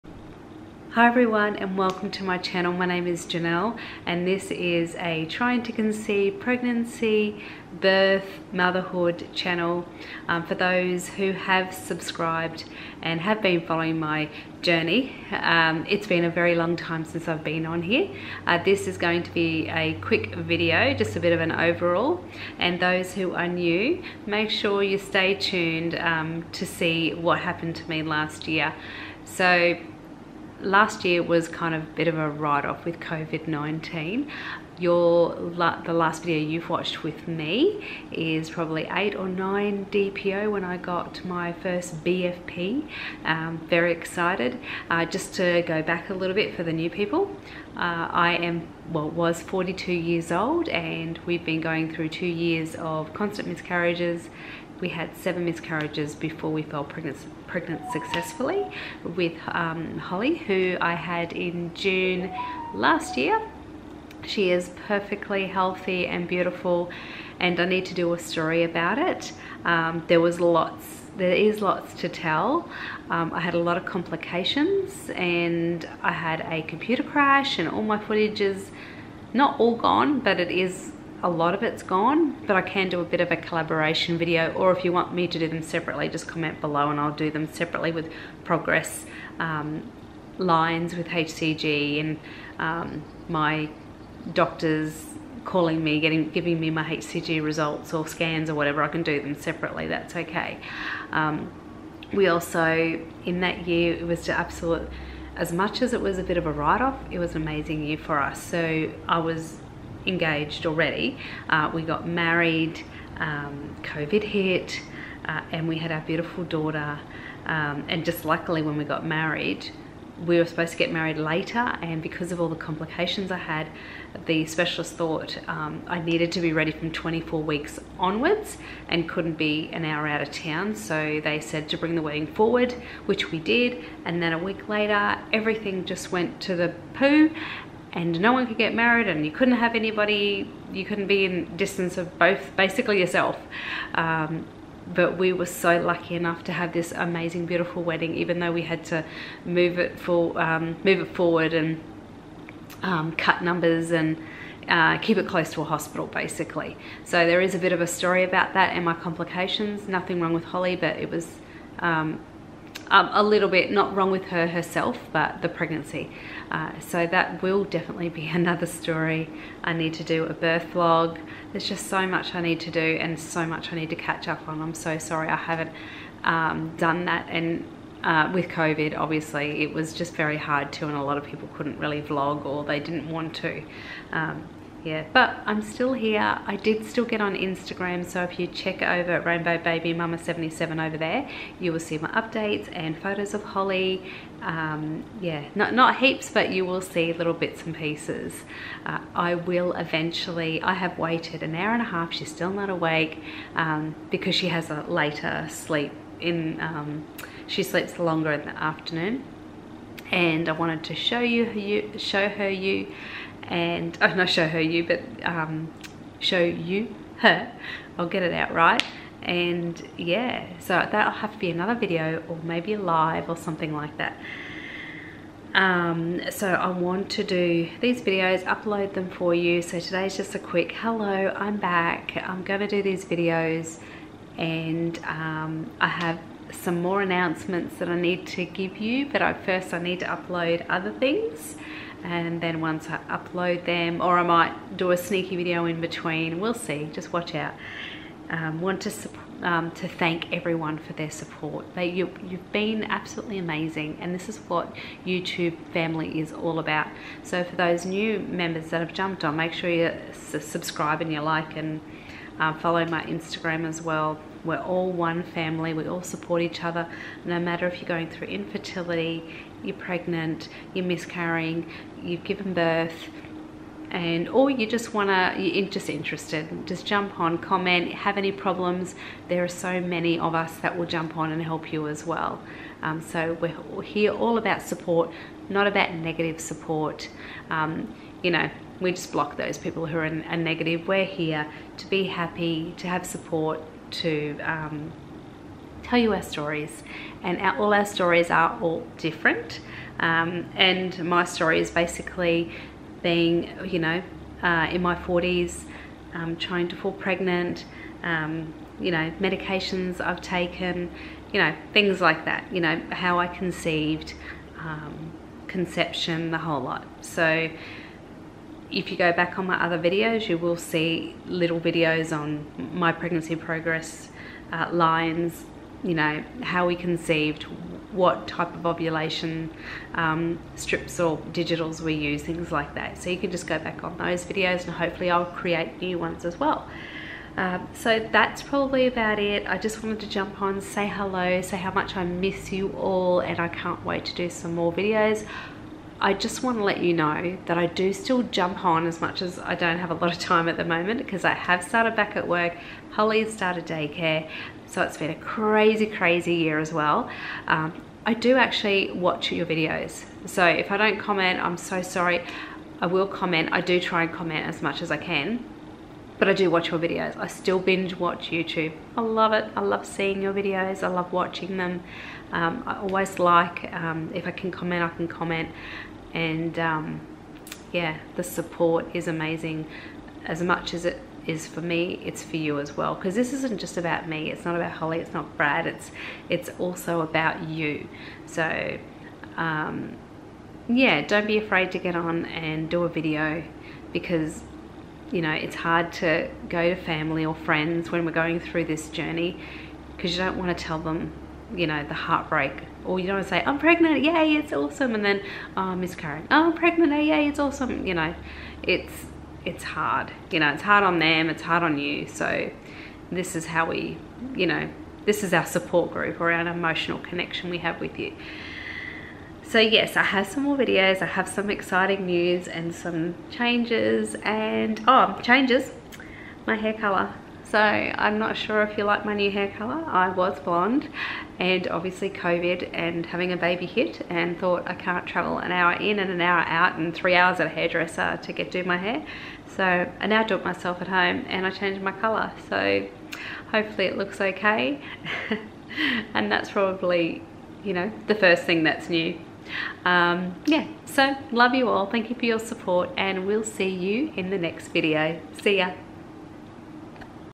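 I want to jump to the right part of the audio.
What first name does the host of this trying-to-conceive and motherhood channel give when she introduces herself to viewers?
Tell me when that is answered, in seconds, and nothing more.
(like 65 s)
3 s.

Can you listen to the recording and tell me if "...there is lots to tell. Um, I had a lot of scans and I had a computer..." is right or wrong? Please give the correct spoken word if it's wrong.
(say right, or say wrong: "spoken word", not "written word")
wrong: "complications", not "scans".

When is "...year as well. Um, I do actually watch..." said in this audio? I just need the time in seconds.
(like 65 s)
356 s.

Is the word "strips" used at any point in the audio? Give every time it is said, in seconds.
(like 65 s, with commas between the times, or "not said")
330 s.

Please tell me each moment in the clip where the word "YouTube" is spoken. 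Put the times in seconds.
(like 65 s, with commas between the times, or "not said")
255 s, 368 s.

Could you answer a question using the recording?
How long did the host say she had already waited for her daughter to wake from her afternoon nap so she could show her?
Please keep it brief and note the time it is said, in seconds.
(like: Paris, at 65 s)
an hour and a half, at 201 s.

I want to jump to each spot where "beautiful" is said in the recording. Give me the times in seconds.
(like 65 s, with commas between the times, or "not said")
66 s, 116 s, 147 s.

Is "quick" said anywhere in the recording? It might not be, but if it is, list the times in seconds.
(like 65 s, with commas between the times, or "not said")
20 s, 230 s.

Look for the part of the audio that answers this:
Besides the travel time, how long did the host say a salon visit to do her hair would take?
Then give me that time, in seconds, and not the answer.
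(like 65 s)
436 s.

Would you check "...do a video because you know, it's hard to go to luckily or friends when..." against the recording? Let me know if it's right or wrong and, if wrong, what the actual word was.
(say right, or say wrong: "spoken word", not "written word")
wrong: "family", not "luckily".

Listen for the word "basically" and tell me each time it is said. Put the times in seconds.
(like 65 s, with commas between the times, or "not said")
142 s, 156 s, 301 s.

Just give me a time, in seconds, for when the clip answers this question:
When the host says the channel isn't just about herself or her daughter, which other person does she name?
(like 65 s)
385 s.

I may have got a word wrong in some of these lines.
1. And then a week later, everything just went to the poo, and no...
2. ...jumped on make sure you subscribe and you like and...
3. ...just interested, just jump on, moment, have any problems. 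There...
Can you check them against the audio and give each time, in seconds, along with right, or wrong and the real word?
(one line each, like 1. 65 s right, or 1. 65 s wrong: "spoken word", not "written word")
1. 134 s right
2. 258 s right
3. 275 s wrong: "comment", not "moment".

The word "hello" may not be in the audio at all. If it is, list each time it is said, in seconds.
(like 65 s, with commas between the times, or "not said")
230 s, 340 s.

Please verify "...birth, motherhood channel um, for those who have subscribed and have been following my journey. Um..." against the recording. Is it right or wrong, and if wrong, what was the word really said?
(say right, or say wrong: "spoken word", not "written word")
right.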